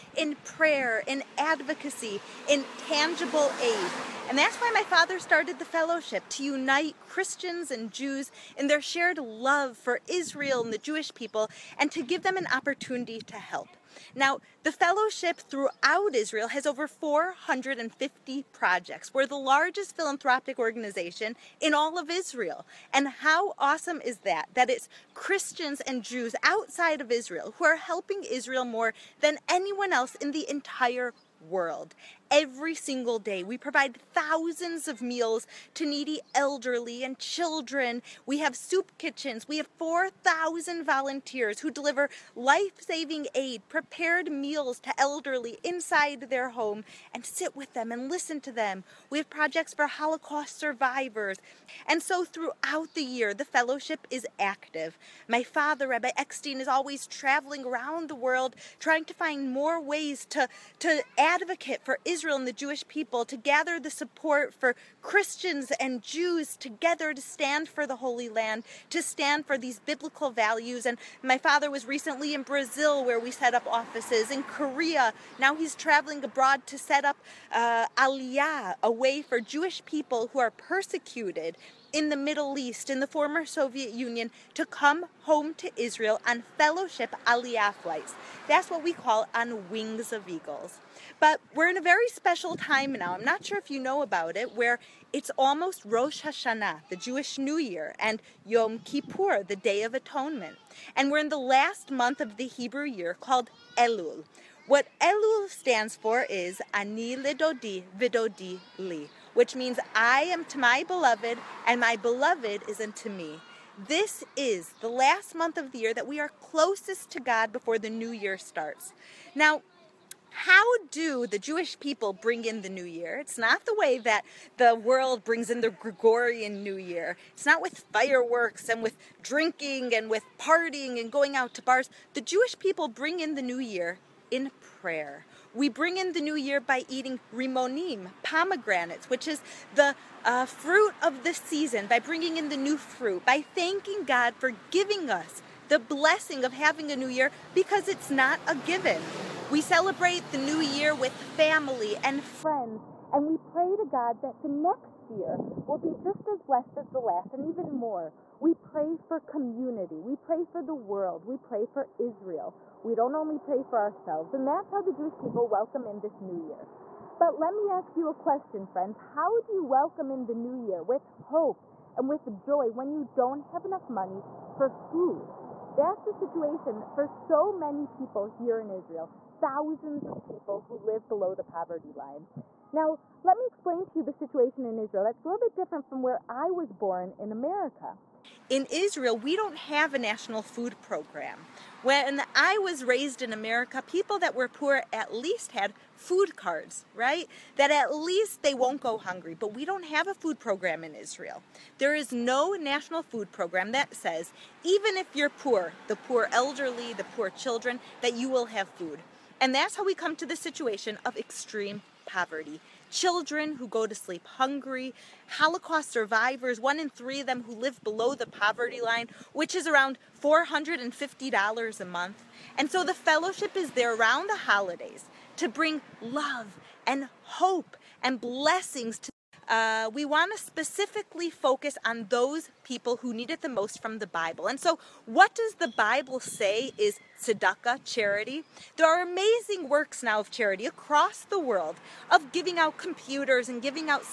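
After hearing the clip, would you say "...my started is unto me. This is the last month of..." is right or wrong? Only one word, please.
wrong.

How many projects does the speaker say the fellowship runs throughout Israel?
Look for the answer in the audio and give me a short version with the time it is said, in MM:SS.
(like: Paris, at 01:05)
over 450, at 00:16.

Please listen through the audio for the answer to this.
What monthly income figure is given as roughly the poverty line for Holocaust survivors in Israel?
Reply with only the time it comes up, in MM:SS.
03:40.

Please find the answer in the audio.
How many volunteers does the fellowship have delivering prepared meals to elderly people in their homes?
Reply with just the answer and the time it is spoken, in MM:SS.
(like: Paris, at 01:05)
4,000, at 00:39.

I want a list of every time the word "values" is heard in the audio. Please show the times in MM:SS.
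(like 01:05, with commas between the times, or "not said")
01:10.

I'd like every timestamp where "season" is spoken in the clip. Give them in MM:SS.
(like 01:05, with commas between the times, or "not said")
02:21.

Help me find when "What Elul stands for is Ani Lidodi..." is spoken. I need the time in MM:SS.
01:44.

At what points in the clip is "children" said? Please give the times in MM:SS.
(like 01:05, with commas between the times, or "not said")
00:37, 03:27, 03:32.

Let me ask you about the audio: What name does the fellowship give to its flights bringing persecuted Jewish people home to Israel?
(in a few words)
On Wings of Eagles.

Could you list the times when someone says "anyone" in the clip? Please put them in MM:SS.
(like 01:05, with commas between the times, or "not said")
00:29.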